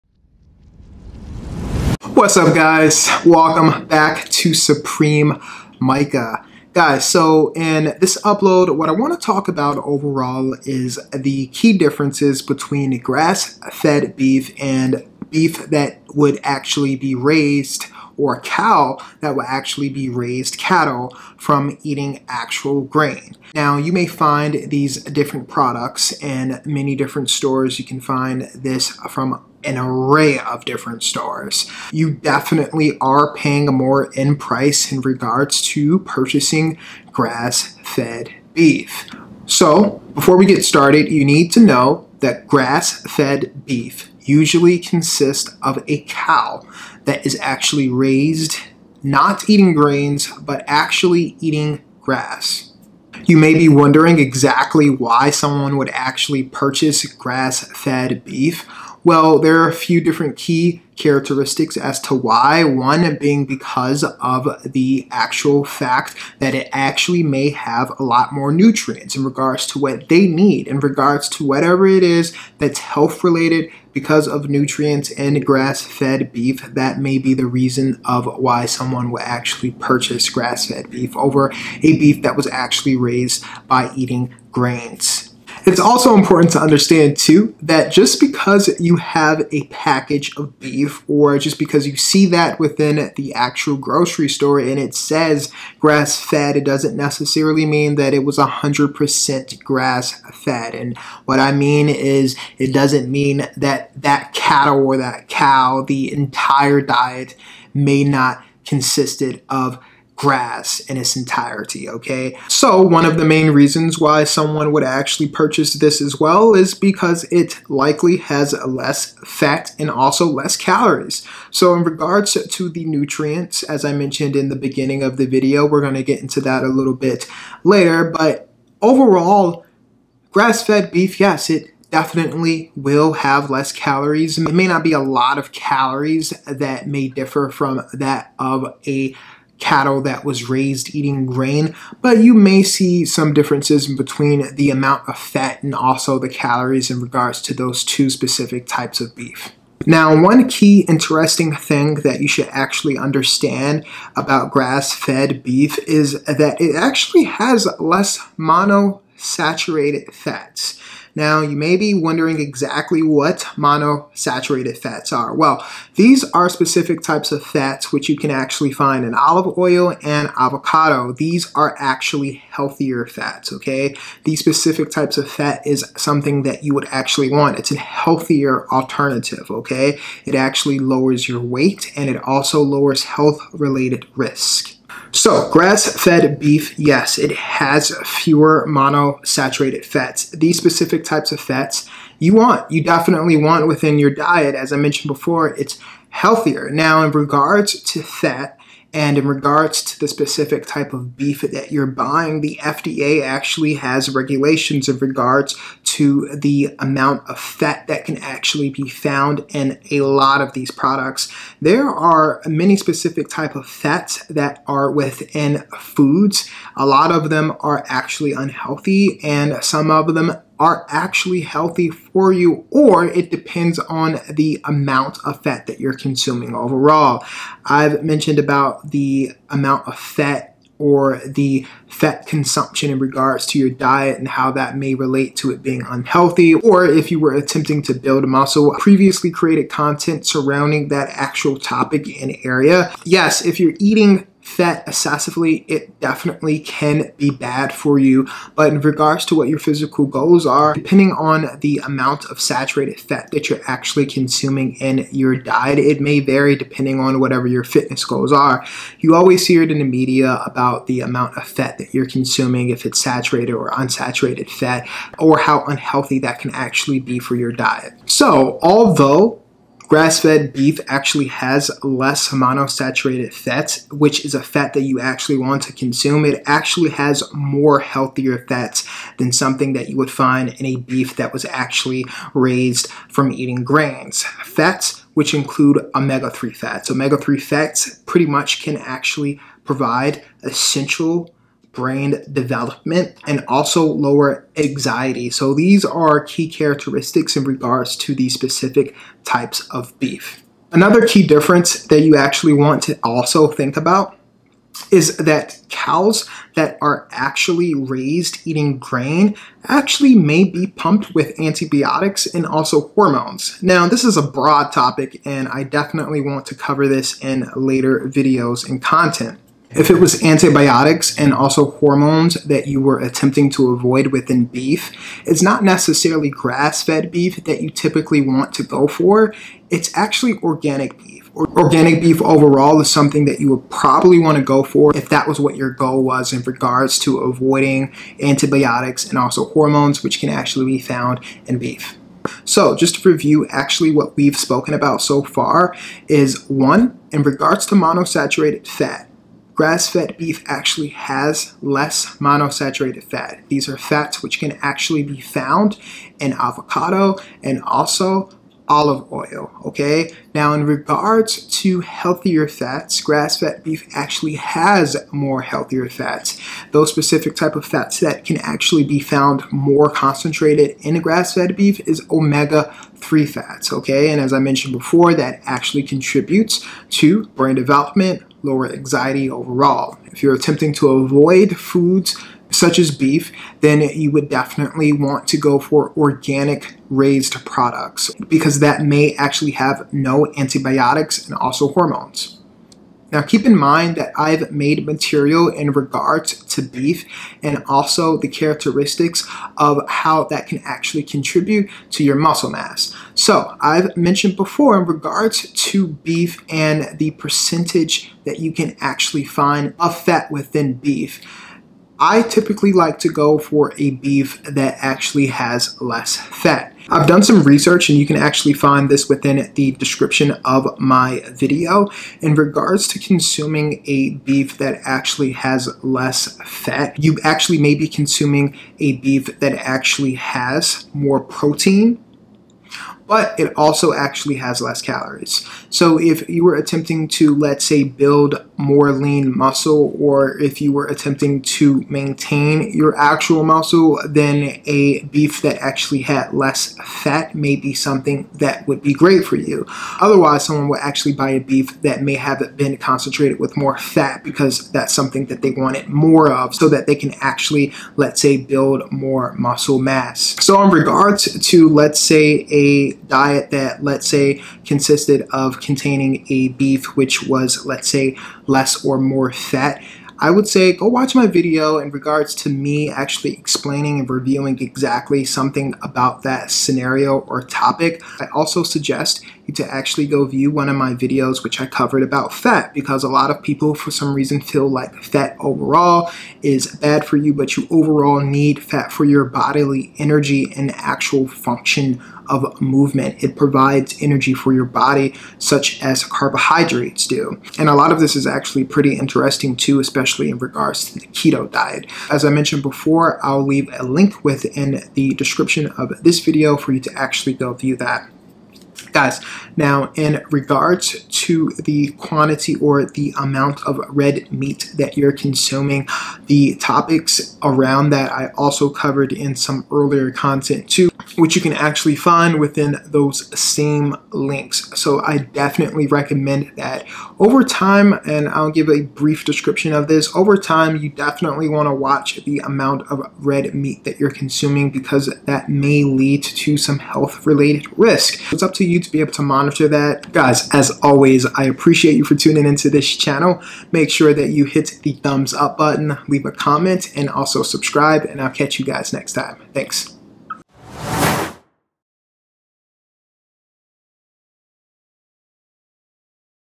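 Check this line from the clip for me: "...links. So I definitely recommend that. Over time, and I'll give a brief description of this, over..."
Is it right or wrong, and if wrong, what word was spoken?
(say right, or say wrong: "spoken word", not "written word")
right.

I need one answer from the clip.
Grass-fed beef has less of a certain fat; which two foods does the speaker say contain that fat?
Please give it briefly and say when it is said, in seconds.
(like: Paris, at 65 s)
Olive oil and avocado, at 169 s.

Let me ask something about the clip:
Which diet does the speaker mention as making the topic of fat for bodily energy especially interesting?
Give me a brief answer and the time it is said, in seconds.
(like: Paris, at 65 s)
Keto diet, at 501 s.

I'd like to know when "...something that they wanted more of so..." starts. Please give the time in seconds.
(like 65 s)
454 s.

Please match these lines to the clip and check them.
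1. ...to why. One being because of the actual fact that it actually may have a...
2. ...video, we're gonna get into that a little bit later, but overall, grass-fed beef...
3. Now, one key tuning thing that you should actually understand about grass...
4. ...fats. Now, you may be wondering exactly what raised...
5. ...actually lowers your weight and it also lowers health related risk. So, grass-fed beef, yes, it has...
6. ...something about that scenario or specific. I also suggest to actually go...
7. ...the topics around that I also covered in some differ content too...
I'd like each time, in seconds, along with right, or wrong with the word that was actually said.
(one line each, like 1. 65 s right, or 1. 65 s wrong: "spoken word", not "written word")
1. 61 s right
2. 125 s right
3. 149 s wrong: "interesting", not "tuning"
4. 160 s wrong: "monosaturated", not "raised"
5. 180 s right
6. 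475 s wrong: "topic", not "specific"
7. 516 s wrong: "earlier", not "differ".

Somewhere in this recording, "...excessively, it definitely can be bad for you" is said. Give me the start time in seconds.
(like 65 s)
244 s.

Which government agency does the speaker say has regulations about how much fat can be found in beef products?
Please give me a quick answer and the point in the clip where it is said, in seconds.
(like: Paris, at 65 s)
FDA, at 202 s.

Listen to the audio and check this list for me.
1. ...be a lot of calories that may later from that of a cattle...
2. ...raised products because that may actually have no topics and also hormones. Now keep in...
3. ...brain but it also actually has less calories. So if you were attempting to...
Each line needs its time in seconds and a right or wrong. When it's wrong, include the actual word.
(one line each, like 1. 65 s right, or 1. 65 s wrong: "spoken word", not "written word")
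1. 134 s wrong: "differ", not "later"
2. 386 s wrong: "antibiotics", not "topics"
3. 431 s wrong: "protein", not "brain".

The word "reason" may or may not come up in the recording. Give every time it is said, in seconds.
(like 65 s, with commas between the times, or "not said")
77 s, 113 s, 484 s.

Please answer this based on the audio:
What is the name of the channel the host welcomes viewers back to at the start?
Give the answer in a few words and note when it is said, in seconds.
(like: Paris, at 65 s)
Supreme Micah, at 4 s.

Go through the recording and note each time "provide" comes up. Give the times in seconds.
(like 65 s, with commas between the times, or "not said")
289 s, 493 s.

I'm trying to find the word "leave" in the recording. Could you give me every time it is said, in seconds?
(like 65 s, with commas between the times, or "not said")
503 s, 546 s.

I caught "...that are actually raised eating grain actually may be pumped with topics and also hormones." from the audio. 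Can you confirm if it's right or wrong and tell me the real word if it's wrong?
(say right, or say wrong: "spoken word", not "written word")
wrong: "antibiotics", not "topics".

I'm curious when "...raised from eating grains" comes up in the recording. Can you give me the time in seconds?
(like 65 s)
282 s.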